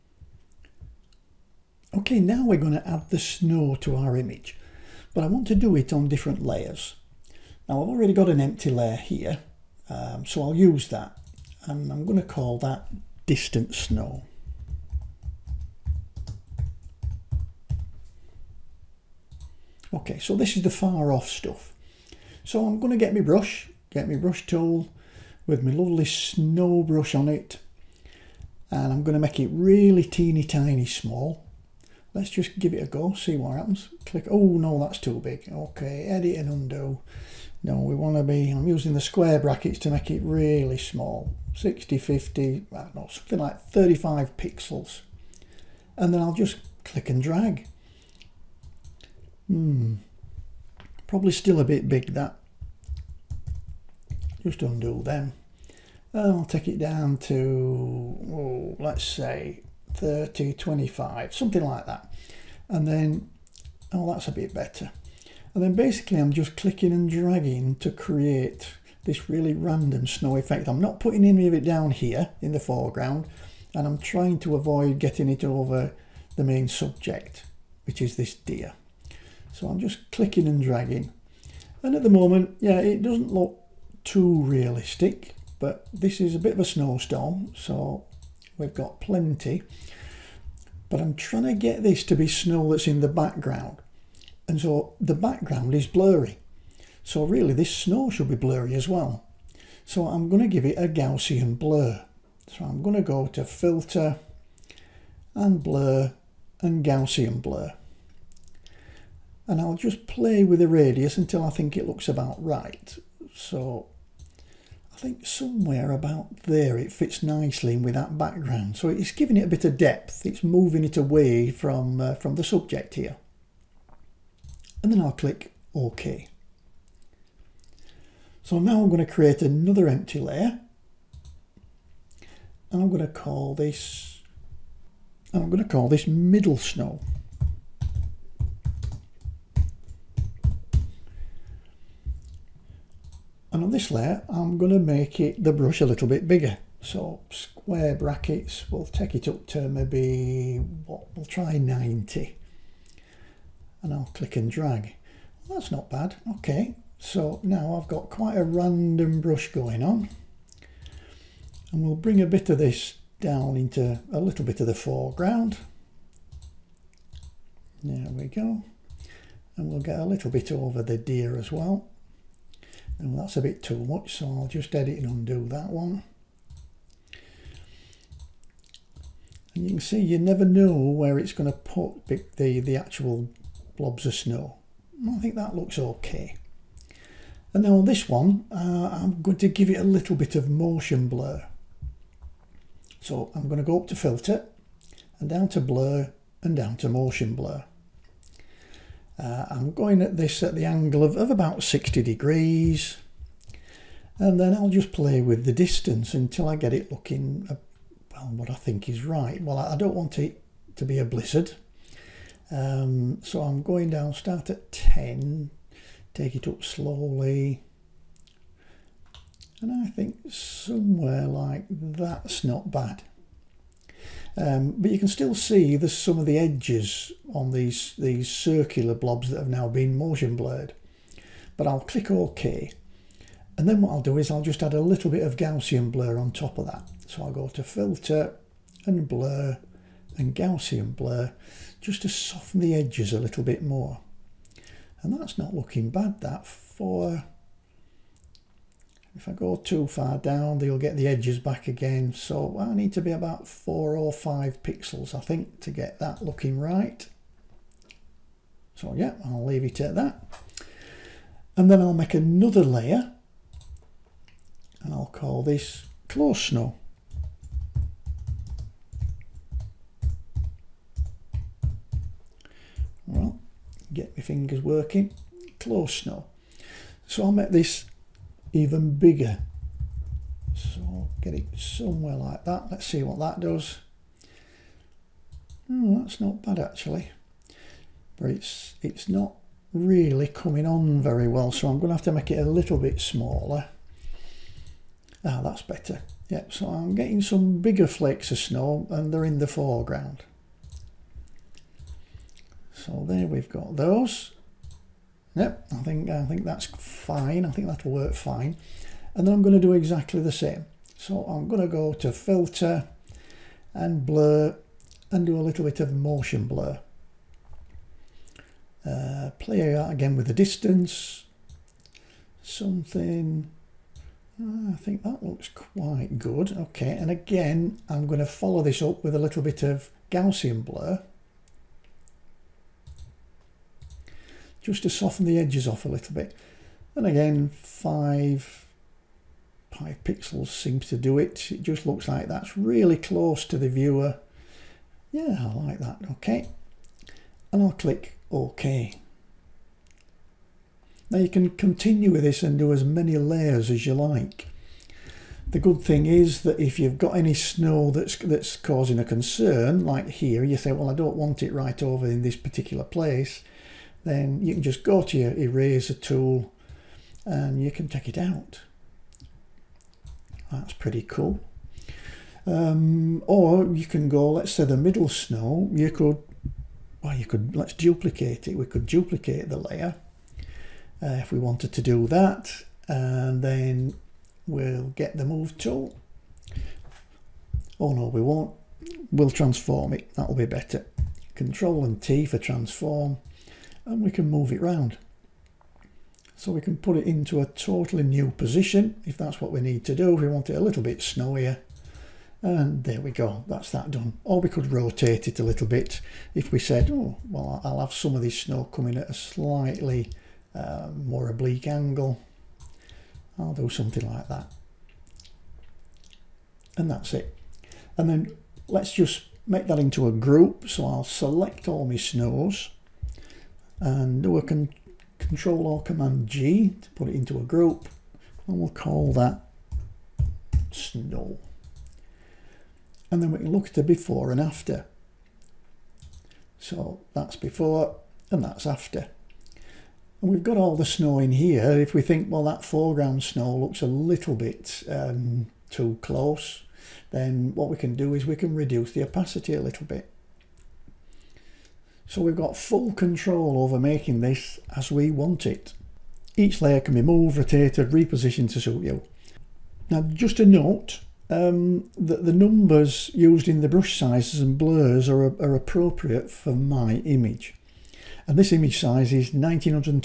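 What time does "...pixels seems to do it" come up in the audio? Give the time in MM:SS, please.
05:40.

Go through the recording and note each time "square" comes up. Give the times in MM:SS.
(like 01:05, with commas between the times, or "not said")
00:39, 02:27.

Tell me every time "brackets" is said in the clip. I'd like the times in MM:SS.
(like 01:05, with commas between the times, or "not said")
00:39, 02:27.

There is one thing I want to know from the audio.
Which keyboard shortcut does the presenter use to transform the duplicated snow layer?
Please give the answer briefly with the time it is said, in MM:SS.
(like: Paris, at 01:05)
Control and T, at 06:31.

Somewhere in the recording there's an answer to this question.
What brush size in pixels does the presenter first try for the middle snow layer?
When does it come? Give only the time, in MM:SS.
02:31.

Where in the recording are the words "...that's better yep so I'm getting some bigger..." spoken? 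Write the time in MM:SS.
04:55.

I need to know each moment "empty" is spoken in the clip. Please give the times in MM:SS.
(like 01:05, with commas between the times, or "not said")
00:08, 02:09.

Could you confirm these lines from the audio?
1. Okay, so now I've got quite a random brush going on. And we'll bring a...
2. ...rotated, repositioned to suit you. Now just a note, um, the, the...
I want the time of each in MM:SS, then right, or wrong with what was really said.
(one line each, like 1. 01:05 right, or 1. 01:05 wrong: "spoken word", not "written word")
1. 02:36 right
2. 07:37 right.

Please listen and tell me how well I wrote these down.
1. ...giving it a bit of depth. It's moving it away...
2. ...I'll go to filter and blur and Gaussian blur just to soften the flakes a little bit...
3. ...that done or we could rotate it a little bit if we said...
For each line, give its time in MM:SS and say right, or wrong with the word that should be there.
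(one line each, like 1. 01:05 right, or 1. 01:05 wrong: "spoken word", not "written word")
1. 01:59 right
2. 03:57 wrong: "edges", not "flakes"
3. 06:43 right.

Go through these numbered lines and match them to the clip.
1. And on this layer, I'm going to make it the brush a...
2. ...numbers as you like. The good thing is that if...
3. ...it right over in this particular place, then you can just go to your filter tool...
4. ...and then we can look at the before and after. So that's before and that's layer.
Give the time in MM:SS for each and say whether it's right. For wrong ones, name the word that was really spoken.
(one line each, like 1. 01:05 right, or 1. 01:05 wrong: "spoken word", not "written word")
1. 02:23 right
2. 05:53 wrong: "layers", not "numbers"
3. 06:01 wrong: "eraser", not "filter"
4. 07:13 wrong: "after", not "layer".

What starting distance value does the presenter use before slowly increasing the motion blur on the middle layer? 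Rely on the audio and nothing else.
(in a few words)
10.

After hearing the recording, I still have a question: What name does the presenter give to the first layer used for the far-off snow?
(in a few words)
distant snow.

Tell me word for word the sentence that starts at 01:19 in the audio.
So I'm just clicking and dragging.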